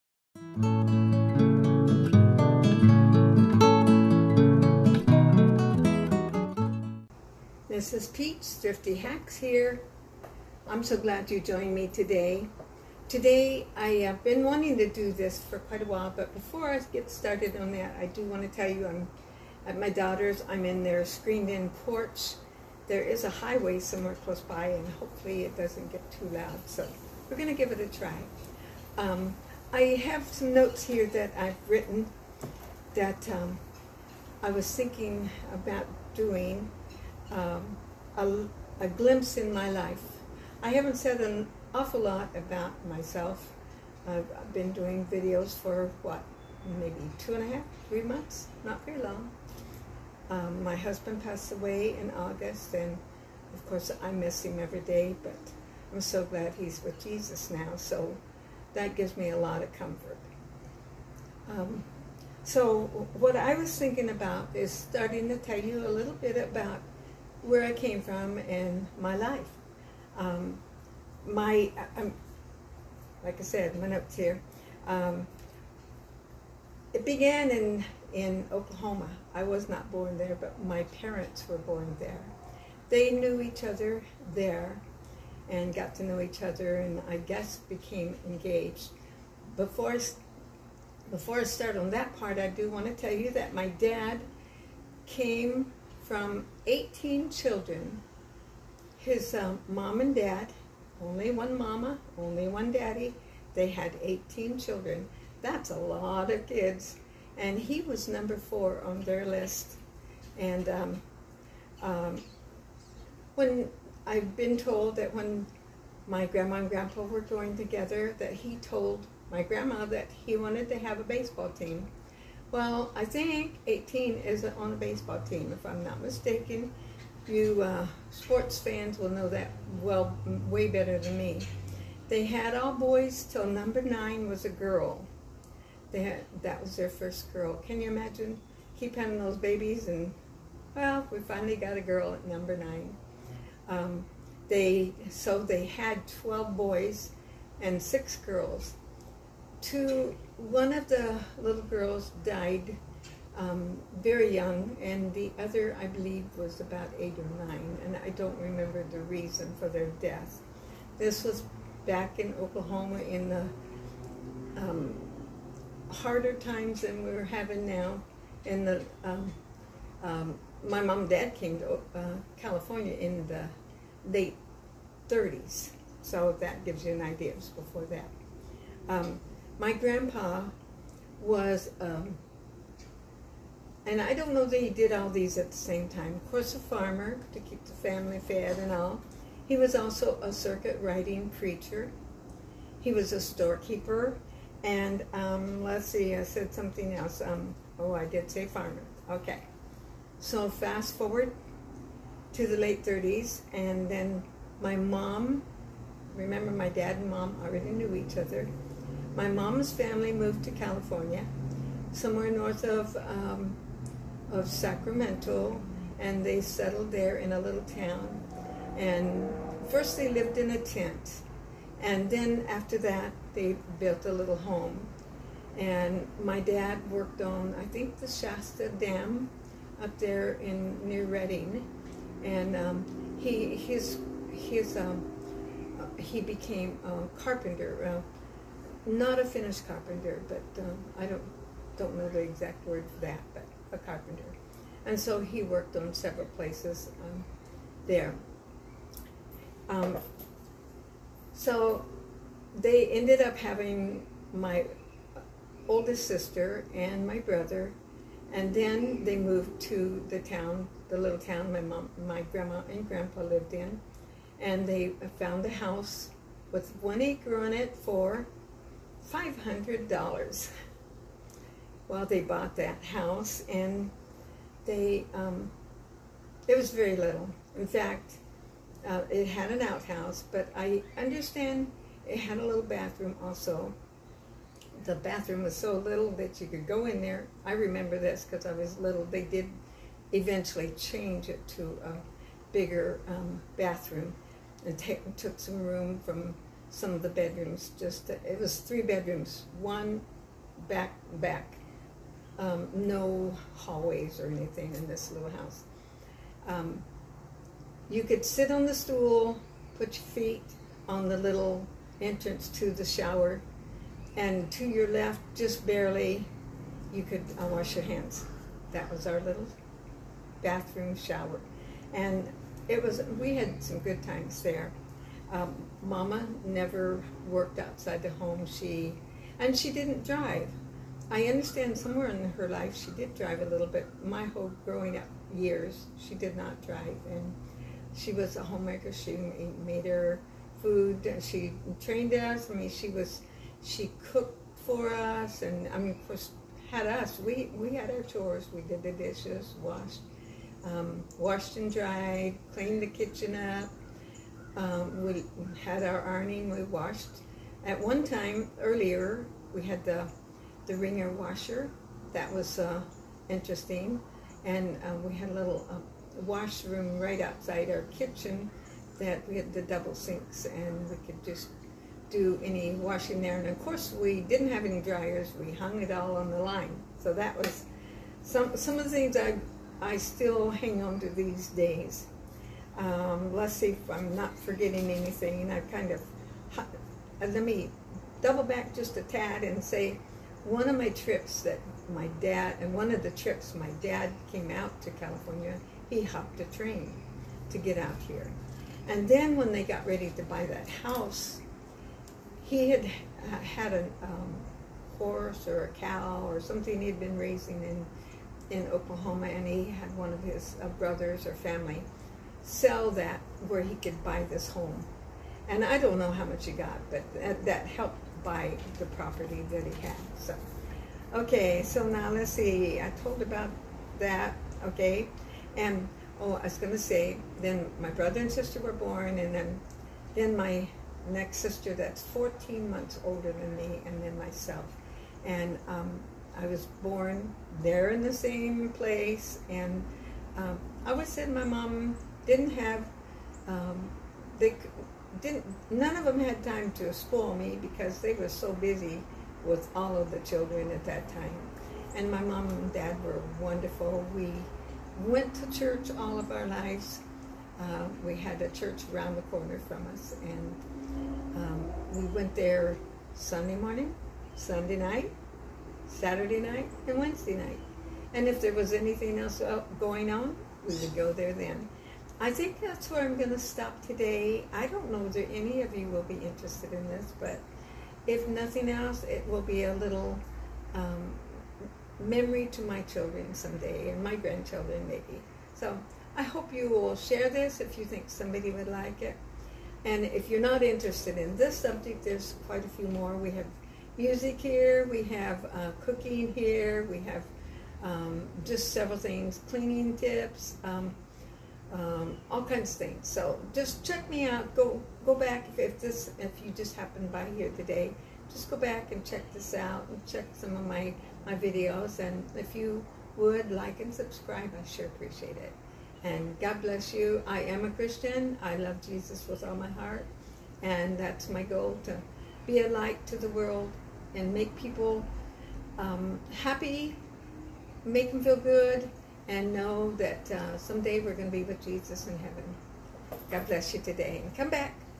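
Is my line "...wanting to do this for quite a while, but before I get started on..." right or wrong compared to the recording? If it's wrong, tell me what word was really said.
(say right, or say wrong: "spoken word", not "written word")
right.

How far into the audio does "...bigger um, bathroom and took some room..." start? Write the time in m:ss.
4:52.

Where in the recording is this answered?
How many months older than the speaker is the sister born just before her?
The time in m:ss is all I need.
7:12.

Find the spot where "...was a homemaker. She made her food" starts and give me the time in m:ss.
5:38.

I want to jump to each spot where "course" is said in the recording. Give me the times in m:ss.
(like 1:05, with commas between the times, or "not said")
0:53, 3:06, 5:46, 6:13.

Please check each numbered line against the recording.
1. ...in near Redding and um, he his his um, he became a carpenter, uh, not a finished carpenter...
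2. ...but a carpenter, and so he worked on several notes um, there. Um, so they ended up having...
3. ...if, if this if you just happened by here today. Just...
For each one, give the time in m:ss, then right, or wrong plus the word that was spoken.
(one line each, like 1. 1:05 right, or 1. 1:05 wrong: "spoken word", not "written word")
1. 3:50 right
2. 4:03 wrong: "places", not "notes"
3. 8:25 right.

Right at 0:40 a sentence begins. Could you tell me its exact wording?
I haven't said an awful lot about myself.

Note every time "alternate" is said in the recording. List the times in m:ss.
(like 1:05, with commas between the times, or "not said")
not said.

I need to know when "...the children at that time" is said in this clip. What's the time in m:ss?
7:30.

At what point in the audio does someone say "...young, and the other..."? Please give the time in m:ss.
2:34.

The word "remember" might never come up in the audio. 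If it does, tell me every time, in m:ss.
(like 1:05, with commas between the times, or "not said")
2:38, 3:26, 4:47.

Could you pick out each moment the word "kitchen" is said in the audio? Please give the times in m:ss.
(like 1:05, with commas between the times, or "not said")
5:52, 6:07.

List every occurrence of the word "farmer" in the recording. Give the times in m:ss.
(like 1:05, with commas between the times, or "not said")
3:06, 3:18.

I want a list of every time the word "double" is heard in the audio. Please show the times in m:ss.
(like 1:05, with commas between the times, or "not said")
6:09, 6:28.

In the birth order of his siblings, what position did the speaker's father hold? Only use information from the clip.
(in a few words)
number four.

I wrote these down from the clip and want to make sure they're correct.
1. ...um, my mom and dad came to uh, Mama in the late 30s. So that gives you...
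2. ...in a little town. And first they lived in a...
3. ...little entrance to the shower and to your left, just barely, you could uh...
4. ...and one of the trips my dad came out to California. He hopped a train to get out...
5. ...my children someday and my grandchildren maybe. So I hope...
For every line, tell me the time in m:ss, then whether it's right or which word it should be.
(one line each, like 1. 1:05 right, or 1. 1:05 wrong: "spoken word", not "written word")
1. 2:50 wrong: "California", not "Mama"
2. 3:37 right
3. 5:11 right
4. 6:32 right
5. 8:02 right.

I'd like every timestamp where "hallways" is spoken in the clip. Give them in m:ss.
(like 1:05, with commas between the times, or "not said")
5:03.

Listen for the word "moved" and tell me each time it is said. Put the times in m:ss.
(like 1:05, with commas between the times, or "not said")
3:30, 4:19.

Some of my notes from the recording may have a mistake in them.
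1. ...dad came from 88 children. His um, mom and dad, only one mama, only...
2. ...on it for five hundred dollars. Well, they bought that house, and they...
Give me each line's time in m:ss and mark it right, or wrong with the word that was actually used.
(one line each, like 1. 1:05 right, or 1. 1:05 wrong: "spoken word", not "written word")
1. 1:33 wrong: "18", not "88"
2. 4:27 right.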